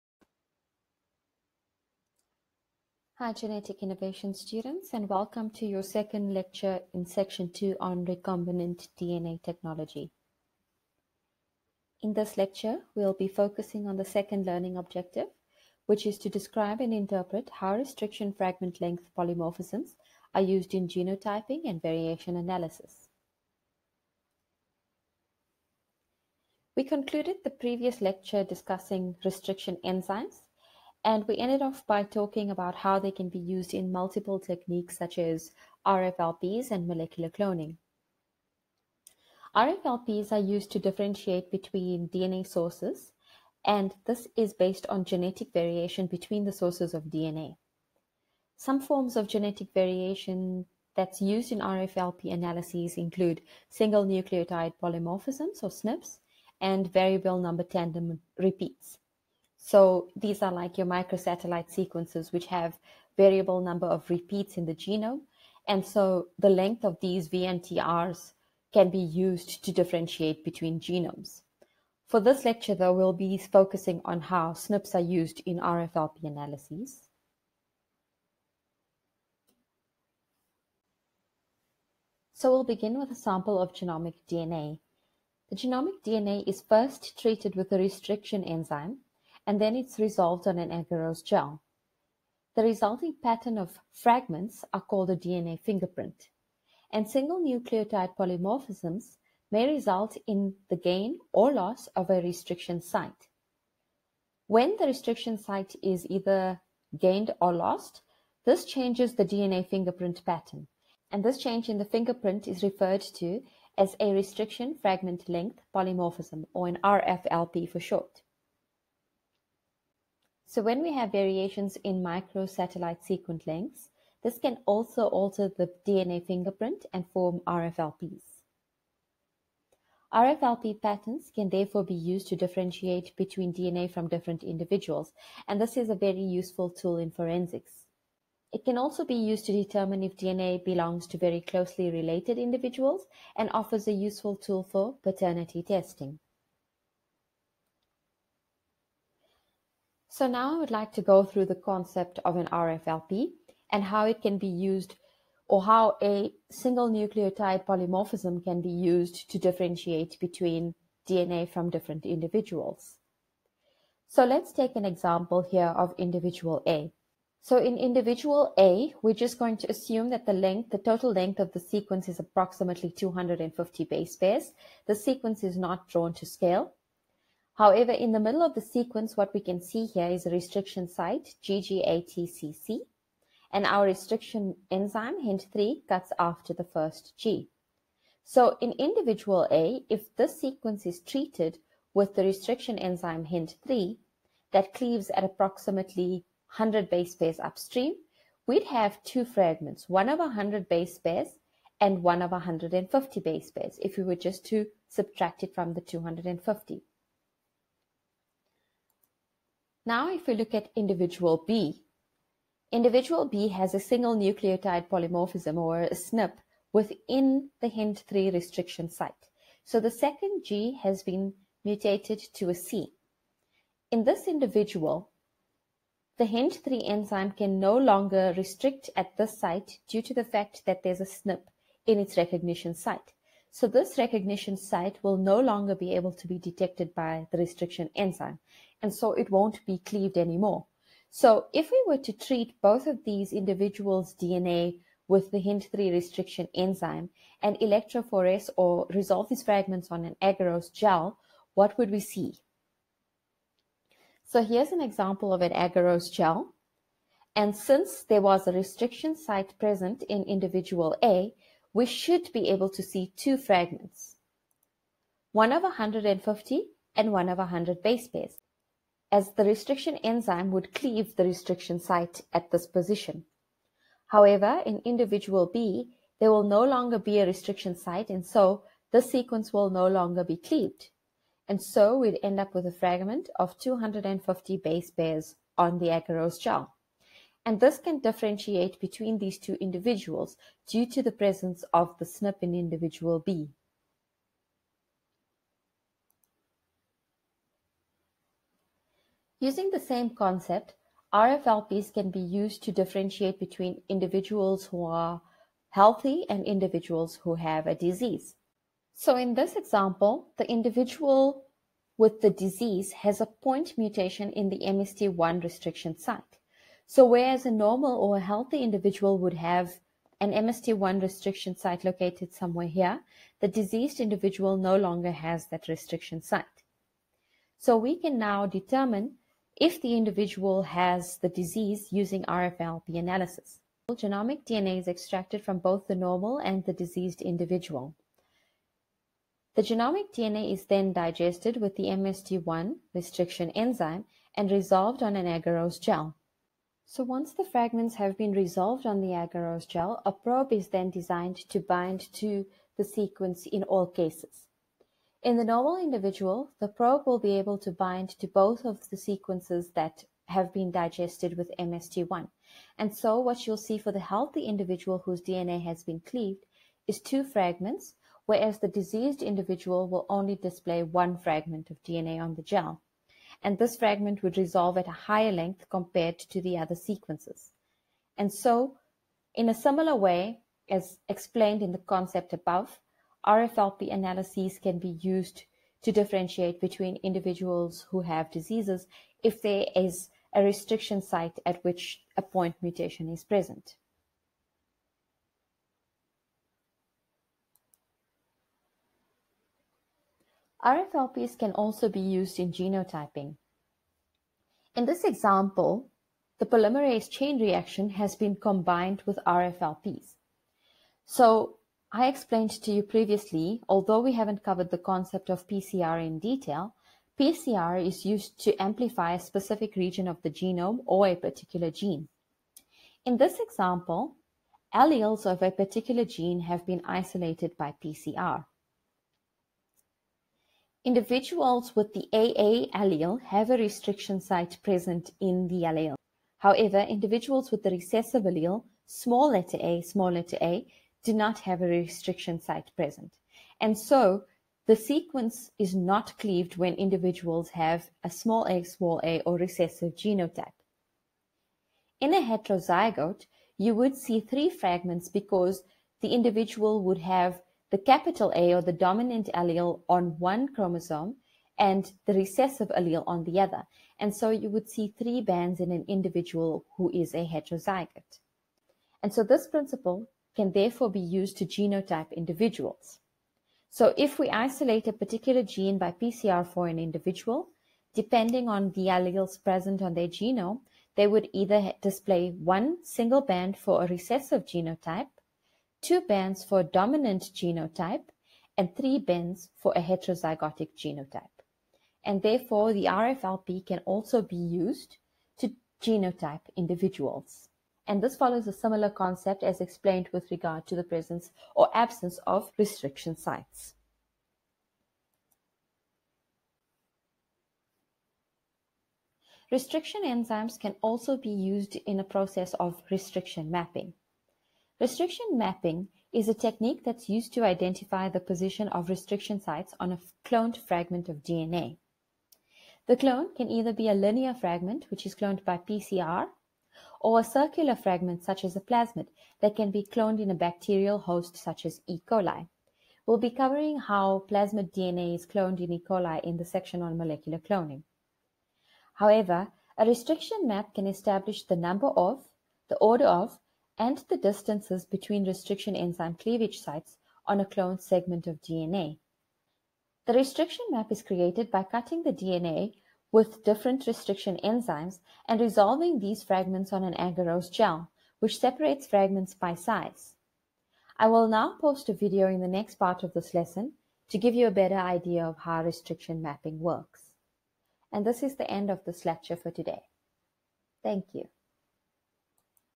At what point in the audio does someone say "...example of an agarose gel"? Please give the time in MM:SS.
04:14.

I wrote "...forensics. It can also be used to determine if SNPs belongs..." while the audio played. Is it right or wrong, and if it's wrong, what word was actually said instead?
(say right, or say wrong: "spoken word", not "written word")
wrong: "DNA", not "SNPs".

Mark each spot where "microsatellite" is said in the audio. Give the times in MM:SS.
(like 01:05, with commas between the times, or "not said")
01:00, 02:02.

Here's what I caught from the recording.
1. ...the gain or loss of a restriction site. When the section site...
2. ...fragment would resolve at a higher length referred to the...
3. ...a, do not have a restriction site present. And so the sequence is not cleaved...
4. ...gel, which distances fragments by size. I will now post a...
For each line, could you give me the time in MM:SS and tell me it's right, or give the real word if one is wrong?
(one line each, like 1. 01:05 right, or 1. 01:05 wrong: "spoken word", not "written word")
1. 01:40 wrong: "restriction", not "section"
2. 06:13 wrong: "compared", not "referred"
3. 07:20 right
4. 09:17 wrong: "separates", not "distances".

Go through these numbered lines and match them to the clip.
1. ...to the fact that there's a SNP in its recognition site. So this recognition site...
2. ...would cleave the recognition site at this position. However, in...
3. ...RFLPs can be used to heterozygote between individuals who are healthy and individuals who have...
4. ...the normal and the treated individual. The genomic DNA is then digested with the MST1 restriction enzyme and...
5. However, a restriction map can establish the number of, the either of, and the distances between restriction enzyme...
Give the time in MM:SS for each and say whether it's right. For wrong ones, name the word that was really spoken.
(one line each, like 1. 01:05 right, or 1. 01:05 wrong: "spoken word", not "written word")
1. 03:50 right
2. 04:30 wrong: "restriction", not "recognition"
3. 05:01 wrong: "differentiate", not "heterozygote"
4. 05:35 wrong: "diseased", not "treated"
5. 08:58 wrong: "order", not "either".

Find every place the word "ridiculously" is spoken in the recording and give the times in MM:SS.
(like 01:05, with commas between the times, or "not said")
not said.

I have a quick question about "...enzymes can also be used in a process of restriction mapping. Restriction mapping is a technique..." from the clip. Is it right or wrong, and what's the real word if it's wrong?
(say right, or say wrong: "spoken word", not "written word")
right.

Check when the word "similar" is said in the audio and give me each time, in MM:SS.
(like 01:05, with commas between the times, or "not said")
06:19, 08:18.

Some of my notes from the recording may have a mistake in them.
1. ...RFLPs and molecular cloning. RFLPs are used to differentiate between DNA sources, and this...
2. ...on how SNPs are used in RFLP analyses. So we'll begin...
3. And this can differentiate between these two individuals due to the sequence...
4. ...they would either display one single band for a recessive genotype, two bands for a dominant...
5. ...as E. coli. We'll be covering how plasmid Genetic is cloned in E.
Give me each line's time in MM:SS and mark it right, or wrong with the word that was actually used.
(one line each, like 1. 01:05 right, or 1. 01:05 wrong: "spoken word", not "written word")
1. 00:35 right
2. 01:14 right
3. 04:47 wrong: "presence", not "sequence"
4. 08:00 right
5. 08:51 wrong: "DNA", not "Genetic".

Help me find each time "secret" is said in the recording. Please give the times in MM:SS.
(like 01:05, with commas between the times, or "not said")
not said.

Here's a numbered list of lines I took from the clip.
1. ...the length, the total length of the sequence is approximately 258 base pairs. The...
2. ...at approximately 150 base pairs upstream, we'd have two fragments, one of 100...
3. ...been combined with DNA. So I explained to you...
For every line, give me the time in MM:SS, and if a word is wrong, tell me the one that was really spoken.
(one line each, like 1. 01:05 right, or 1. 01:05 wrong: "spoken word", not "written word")
1. 02:50 wrong: "250", not "258"
2. 03:15 wrong: "100", not "150"
3. 06:48 wrong: "RFLPs", not "DNA".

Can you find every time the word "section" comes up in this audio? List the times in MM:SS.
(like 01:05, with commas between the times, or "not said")
00:07, 08:56.